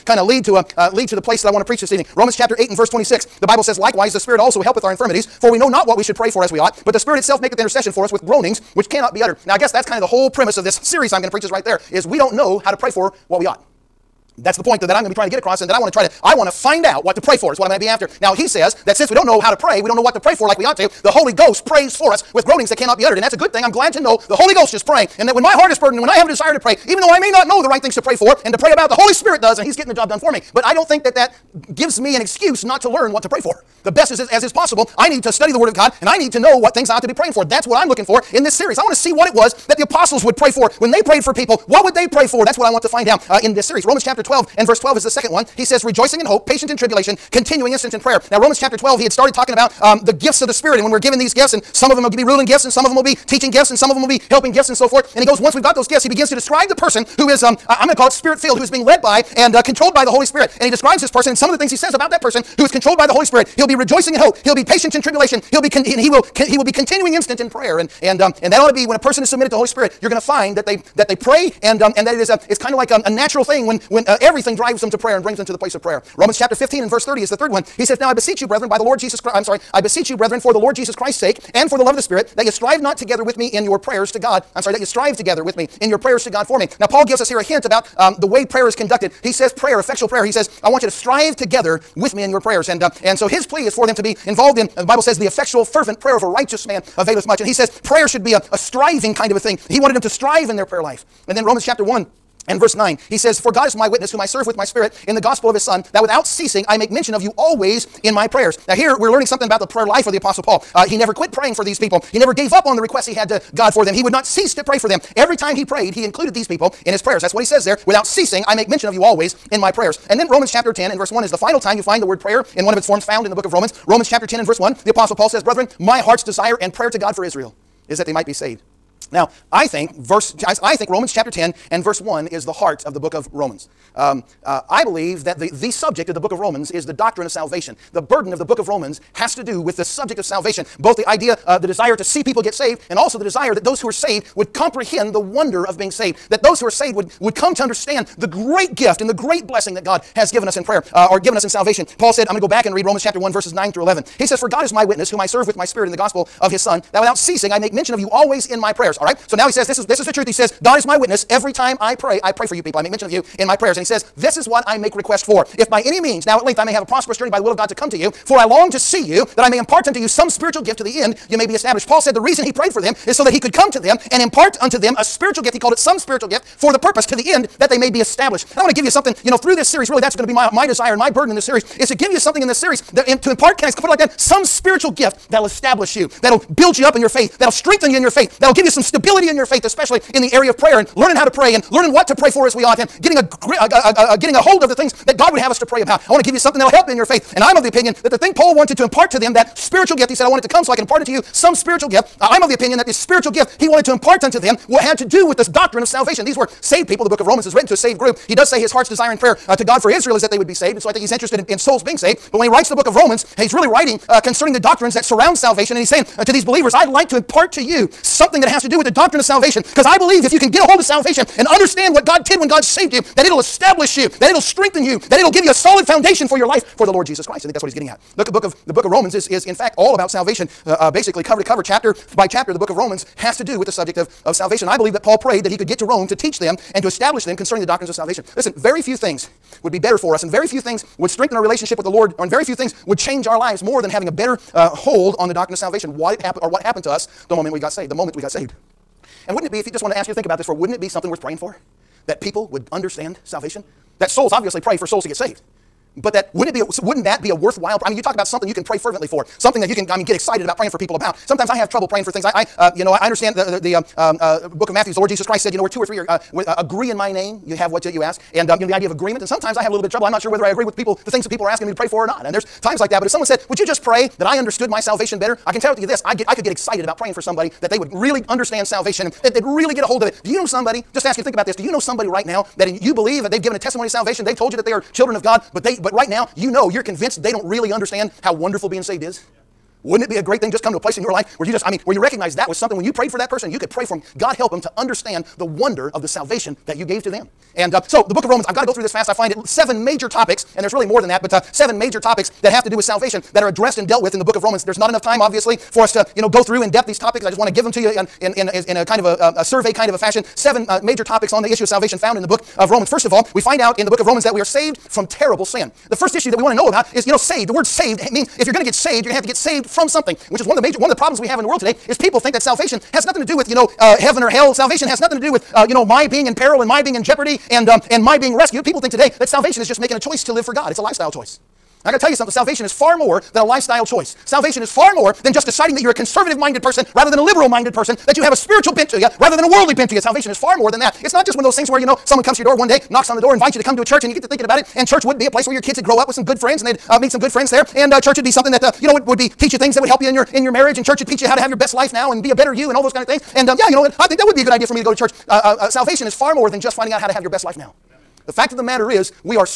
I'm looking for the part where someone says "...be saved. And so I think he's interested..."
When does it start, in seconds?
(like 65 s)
210 s.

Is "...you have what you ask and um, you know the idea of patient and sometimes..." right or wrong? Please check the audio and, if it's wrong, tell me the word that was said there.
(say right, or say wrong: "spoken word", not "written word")
wrong: "agreement", not "patient".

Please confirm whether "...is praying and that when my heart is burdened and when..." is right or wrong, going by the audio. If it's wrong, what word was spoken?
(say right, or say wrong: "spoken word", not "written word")
right.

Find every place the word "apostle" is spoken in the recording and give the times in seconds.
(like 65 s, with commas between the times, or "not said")
39 s, 110 s, 124 s.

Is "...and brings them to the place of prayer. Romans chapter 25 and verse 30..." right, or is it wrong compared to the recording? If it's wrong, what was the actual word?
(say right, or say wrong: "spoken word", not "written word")
wrong: "15", not "25".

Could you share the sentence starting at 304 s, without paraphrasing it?
There's not enough time, obviously, for us to you know go through in depth these topics.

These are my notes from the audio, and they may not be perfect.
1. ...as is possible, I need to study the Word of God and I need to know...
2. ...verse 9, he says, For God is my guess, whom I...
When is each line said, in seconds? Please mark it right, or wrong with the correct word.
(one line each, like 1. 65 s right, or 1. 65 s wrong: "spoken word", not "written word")
1. 34 s right
2. 102 s wrong: "witness", not "guess".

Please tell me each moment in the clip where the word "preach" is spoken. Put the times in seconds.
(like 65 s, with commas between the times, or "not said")
1 s, 11 s.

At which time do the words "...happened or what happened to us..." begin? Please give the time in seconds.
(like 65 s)
246 s.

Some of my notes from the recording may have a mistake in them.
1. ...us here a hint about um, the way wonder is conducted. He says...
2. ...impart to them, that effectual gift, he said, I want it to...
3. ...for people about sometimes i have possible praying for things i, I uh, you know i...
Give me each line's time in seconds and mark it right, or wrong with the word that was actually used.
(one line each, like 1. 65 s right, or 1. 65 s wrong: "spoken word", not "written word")
1. 87 s wrong: "prayer", not "wonder"
2. 198 s wrong: "spiritual", not "effectual"
3. 260 s wrong: "trouble", not "possible".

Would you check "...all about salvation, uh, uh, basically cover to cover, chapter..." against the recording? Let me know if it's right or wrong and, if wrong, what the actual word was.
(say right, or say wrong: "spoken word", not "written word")
right.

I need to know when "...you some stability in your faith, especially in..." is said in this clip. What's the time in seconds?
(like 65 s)
188 s.